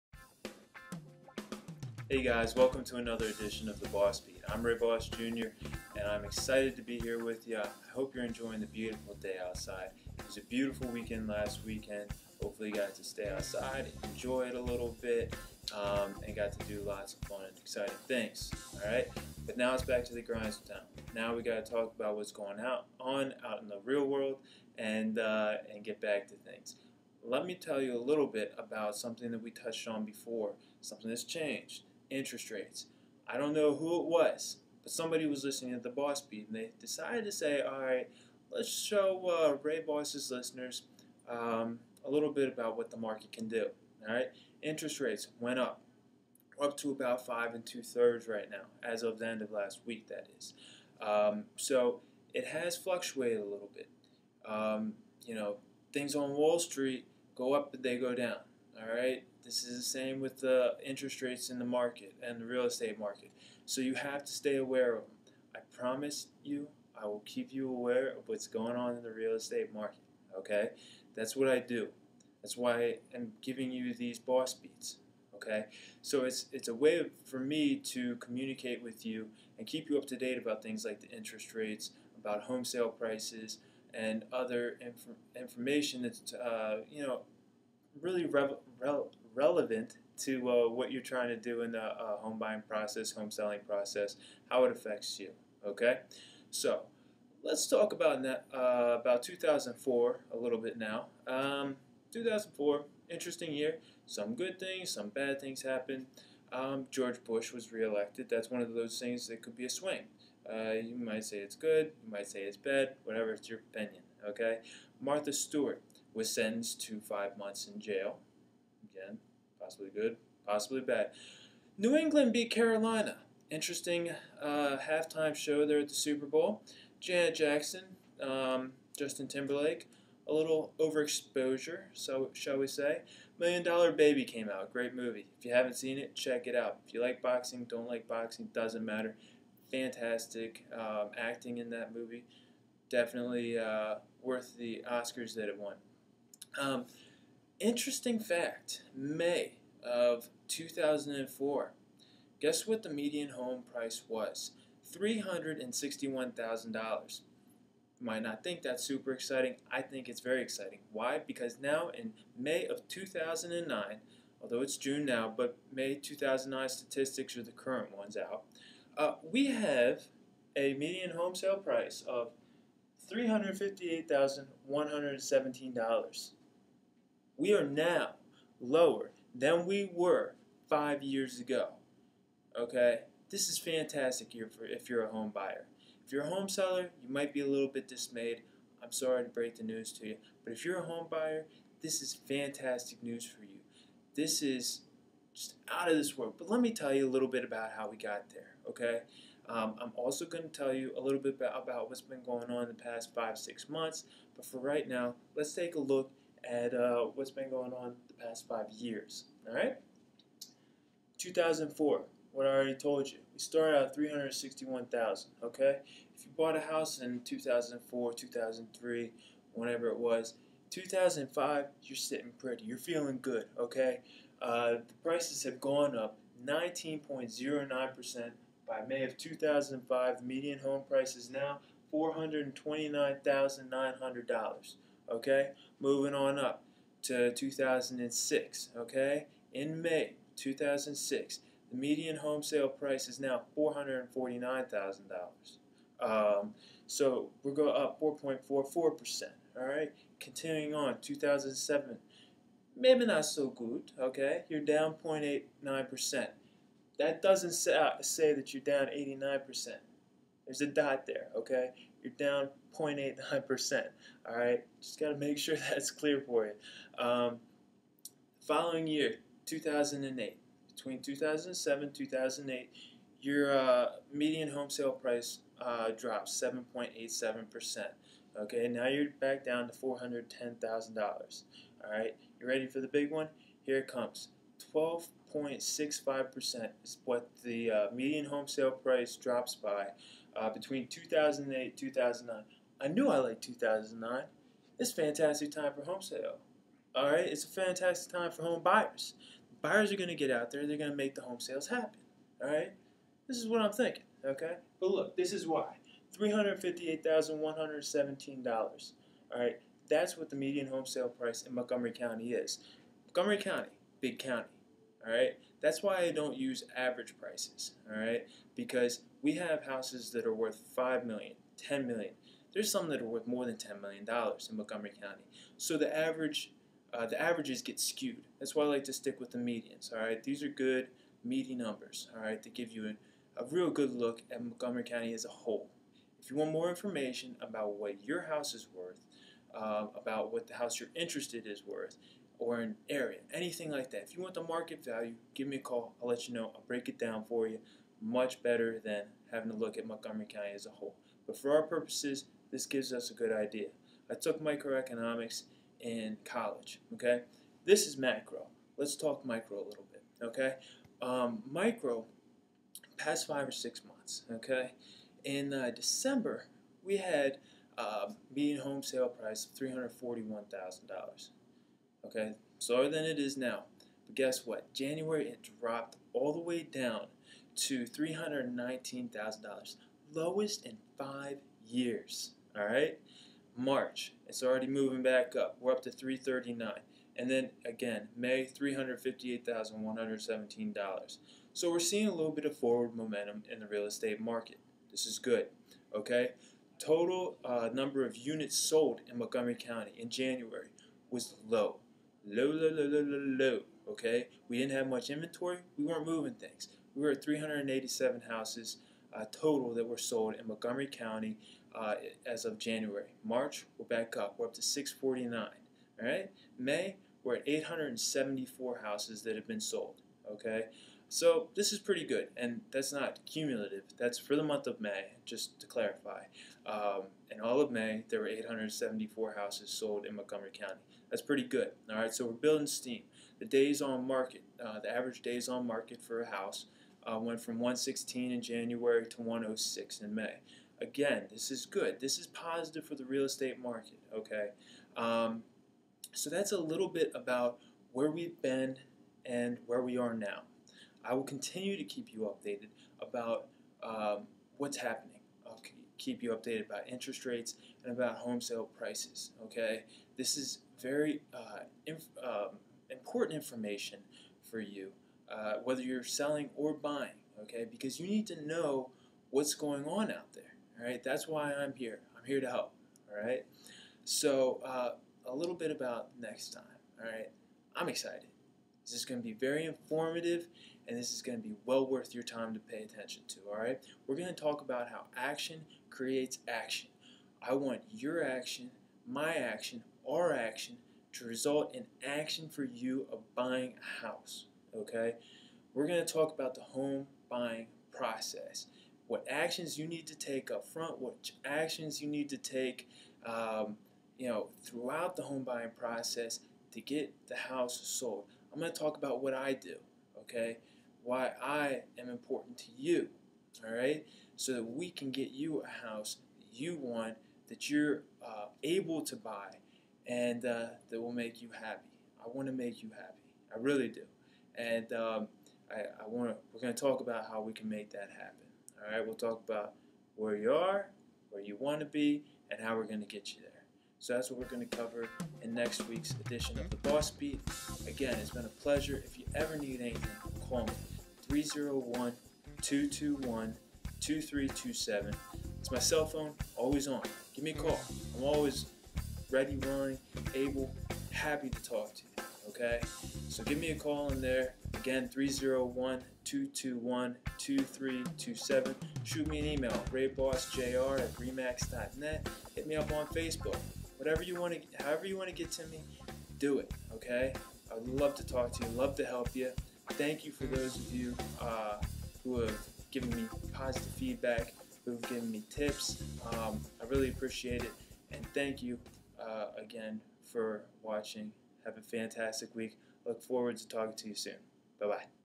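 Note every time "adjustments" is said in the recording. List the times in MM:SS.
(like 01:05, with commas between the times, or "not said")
not said.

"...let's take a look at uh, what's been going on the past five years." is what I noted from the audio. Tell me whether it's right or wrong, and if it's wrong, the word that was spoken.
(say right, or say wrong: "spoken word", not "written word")
right.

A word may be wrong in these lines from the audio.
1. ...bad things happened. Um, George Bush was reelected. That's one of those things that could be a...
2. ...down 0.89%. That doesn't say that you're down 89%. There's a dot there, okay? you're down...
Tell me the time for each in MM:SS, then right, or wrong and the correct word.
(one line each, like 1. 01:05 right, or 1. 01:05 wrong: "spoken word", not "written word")
1. 01:45 right
2. 04:14 right.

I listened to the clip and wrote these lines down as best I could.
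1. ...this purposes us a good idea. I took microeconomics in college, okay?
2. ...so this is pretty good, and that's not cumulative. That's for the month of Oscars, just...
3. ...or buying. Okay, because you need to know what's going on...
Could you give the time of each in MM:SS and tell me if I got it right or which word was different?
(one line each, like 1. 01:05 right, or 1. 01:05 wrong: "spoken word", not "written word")
1. 05:52 wrong: "gives", not "purposes"
2. 07:01 wrong: "May", not "Oscars"
3. 07:46 right.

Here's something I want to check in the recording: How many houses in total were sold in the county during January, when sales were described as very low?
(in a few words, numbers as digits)
387.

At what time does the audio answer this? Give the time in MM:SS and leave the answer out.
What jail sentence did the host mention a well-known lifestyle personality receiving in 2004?
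01:56.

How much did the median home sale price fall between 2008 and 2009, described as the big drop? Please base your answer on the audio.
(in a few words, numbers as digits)
12.65%.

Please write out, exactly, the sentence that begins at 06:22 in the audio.
All right, March it's already moving back up.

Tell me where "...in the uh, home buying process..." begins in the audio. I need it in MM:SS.
01:31.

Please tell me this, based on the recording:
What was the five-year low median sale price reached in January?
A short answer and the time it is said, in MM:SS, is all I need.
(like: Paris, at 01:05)
$319,000, at 06:17.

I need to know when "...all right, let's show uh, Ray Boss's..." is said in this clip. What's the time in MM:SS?
00:37.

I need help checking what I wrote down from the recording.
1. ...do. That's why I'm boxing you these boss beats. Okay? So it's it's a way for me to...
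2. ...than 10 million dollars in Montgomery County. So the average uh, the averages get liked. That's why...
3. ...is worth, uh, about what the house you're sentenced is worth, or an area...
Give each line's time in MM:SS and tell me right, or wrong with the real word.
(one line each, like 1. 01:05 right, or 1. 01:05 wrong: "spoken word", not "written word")
1. 01:11 wrong: "giving", not "boxing"
2. 05:23 wrong: "skewed", not "liked"
3. 05:38 wrong: "interested", not "sentenced".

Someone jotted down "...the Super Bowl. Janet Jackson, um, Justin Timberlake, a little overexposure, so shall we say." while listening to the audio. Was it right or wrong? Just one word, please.
right.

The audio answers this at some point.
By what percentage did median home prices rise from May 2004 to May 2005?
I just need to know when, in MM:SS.
03:46.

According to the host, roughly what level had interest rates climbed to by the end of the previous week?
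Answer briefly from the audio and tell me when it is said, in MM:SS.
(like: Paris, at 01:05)
5 2/3, at 00:47.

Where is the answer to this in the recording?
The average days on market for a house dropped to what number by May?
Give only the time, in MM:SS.
07:19.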